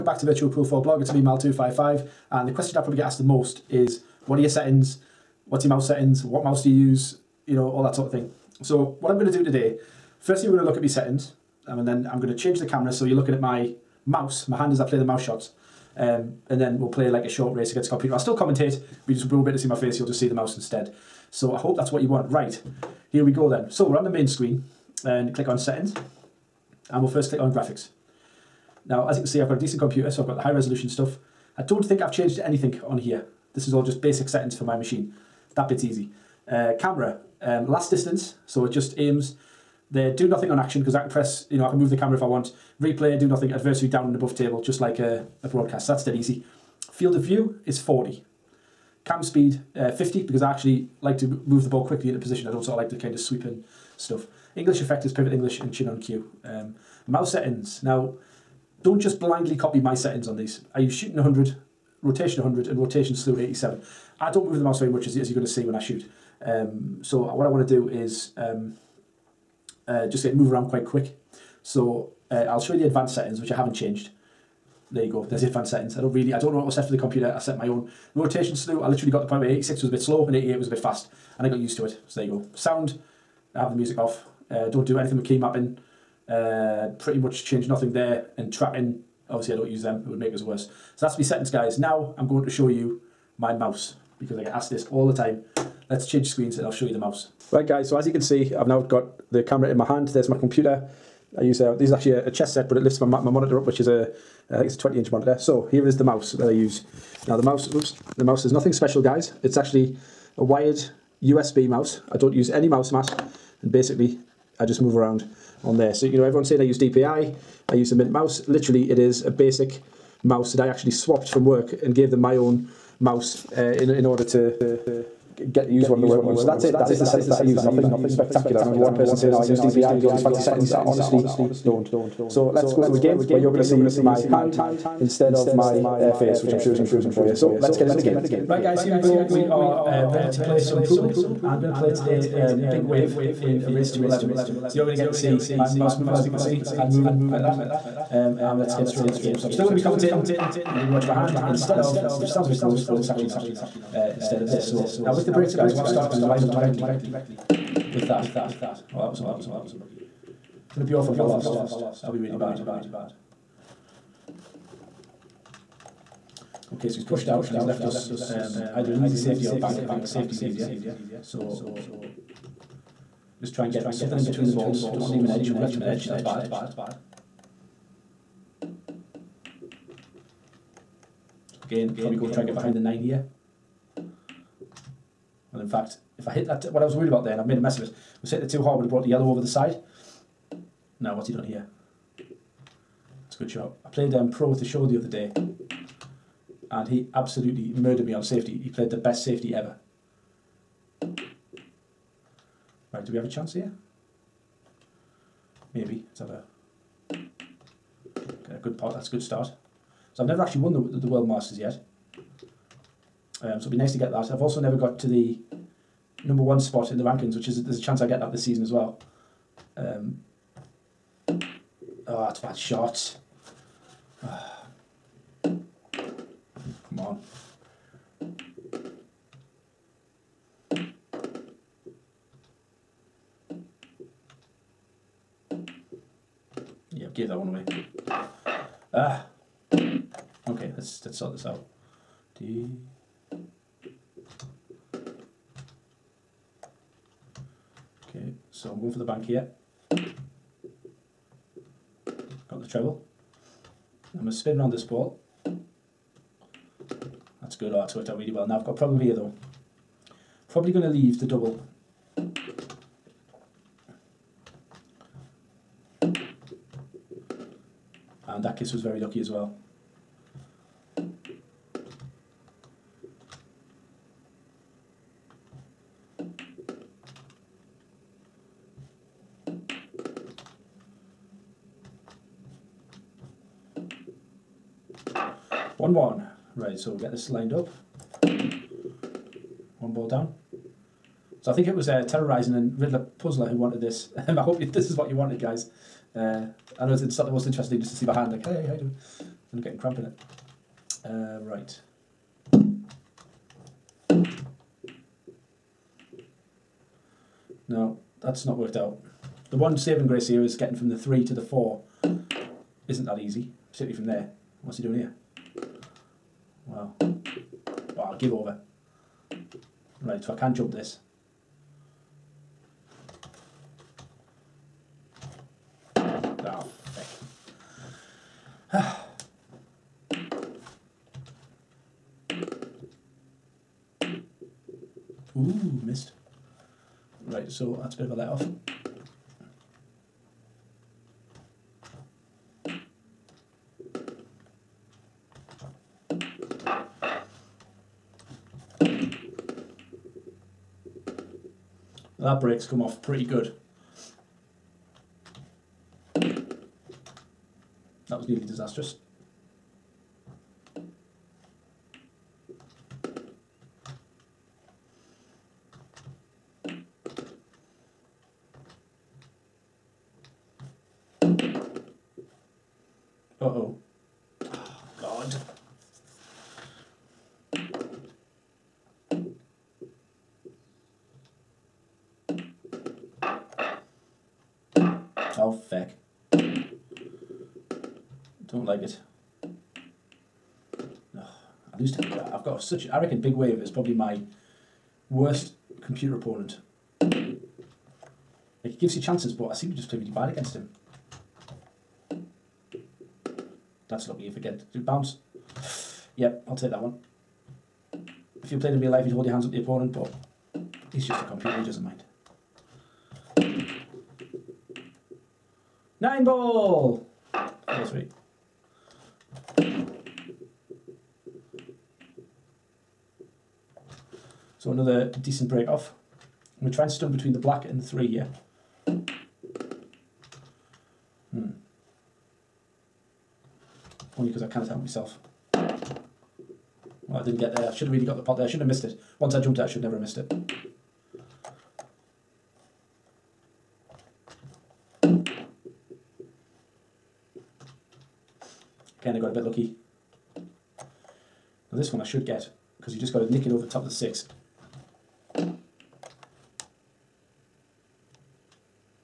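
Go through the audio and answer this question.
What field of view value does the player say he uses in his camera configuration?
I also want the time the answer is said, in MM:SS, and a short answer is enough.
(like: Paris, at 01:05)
40, at 00:46.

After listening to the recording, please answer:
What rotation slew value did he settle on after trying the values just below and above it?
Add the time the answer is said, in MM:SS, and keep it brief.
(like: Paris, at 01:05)
87, at 01:02.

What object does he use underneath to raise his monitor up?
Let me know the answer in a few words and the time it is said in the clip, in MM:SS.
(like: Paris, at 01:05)
A chess set, at 01:42.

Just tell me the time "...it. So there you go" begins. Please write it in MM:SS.
01:21.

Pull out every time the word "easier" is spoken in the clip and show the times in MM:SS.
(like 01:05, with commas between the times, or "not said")
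02:50.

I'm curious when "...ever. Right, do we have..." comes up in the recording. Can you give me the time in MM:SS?
03:19.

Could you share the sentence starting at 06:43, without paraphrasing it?
That's lucky if I get to bounce.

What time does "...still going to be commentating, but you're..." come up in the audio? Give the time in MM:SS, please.
02:29.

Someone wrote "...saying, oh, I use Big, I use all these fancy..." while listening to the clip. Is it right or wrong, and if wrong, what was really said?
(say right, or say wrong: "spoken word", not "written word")
wrong: "DPI", not "Big".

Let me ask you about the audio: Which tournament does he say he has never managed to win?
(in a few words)
World Masters.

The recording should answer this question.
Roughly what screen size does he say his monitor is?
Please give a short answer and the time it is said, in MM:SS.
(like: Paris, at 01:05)
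20 inch, at 01:44.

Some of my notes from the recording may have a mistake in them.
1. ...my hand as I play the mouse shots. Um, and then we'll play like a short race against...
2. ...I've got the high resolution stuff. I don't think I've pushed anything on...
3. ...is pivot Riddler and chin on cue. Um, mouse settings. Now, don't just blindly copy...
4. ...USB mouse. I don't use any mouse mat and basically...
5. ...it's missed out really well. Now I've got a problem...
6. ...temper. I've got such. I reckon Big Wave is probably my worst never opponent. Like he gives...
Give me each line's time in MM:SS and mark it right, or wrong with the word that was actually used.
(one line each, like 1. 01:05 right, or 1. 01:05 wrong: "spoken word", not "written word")
1. 00:14 right
2. 00:30 wrong: "changed", not "pushed"
3. 00:55 wrong: "English", not "Riddler"
4. 01:51 right
5. 04:17 wrong: "worked", not "missed"
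6. 06:31 wrong: "computer", not "never".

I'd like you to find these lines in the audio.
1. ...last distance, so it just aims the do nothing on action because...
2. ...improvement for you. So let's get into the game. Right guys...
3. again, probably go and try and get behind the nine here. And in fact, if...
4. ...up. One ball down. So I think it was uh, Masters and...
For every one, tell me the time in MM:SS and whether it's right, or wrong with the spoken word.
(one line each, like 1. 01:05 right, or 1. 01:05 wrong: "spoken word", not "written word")
1. 00:37 right
2. 02:16 right
3. 03:01 right
4. 04:47 wrong: "Terrorizing", not "Masters".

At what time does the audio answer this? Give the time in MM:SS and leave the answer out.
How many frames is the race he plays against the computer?
02:23.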